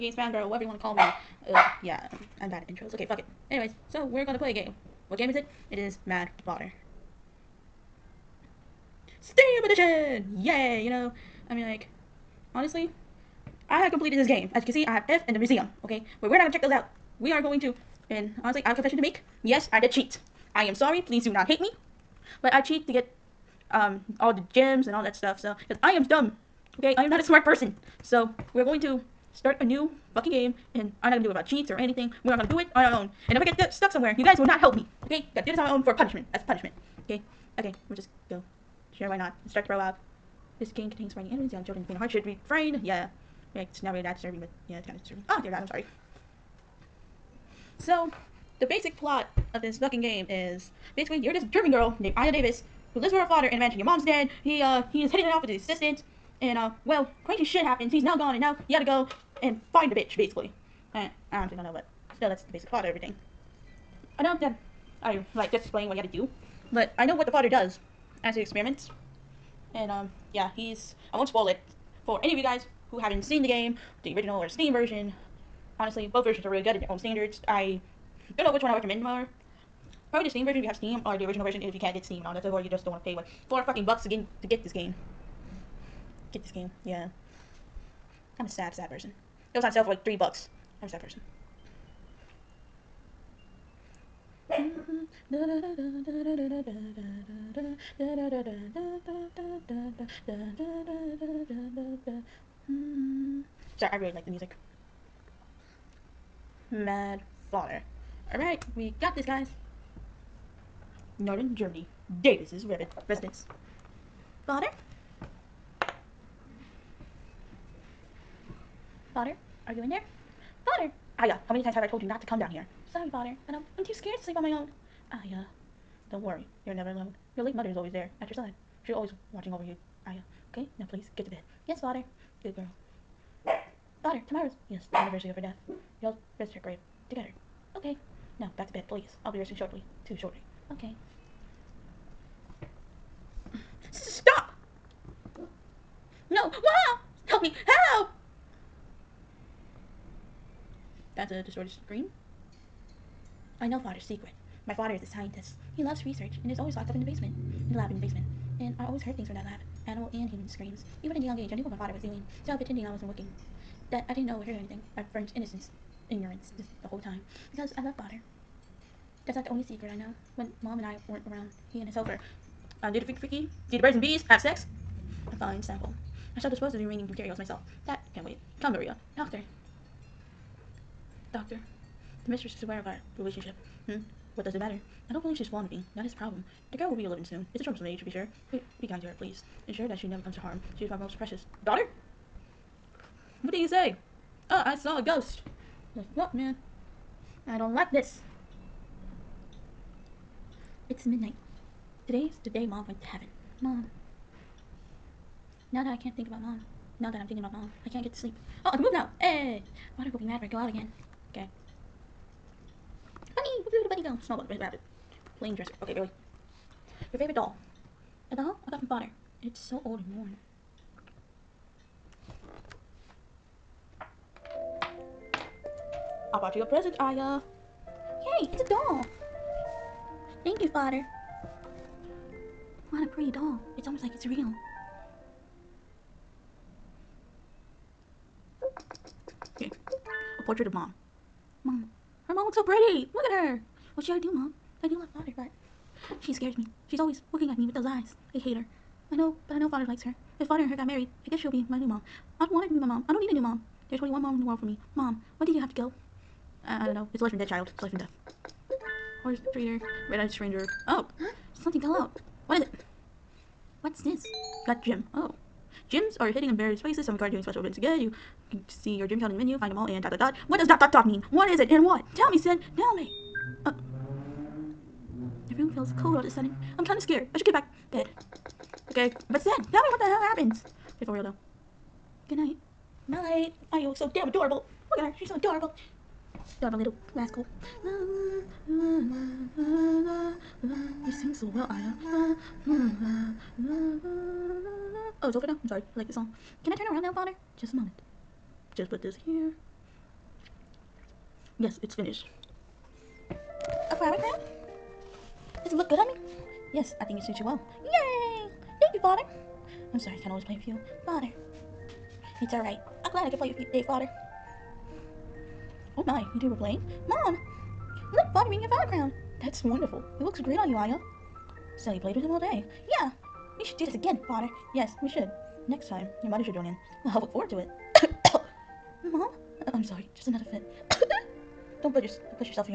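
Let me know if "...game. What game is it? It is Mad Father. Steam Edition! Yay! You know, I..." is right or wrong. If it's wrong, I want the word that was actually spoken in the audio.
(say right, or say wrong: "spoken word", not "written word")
right.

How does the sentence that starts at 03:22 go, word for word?
Today's the day Mom went to heaven.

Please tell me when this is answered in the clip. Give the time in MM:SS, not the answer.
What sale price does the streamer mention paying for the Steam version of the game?
01:30.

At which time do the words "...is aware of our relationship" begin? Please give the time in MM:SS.
03:02.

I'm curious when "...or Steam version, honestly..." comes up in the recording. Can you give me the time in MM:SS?
01:14.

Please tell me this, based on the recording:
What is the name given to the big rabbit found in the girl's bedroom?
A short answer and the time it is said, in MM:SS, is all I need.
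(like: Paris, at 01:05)
Snowball, at 03:34.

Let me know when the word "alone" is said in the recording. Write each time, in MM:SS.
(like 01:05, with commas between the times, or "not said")
02:06.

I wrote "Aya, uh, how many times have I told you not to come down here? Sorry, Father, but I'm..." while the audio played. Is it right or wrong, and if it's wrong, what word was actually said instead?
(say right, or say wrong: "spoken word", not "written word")
right.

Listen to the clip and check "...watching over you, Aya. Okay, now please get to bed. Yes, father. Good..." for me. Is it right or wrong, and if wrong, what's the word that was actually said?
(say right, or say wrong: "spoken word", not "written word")
right.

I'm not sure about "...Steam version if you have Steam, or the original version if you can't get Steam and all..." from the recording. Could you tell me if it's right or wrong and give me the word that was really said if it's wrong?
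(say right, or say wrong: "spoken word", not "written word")
right.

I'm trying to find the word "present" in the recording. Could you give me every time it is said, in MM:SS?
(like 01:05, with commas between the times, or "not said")
03:46.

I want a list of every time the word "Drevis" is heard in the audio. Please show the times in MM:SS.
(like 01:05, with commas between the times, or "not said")
00:52, 01:52.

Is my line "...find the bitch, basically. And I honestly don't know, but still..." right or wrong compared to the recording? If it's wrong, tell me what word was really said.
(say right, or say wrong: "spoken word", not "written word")
right.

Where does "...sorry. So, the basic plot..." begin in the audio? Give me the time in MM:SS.
00:45.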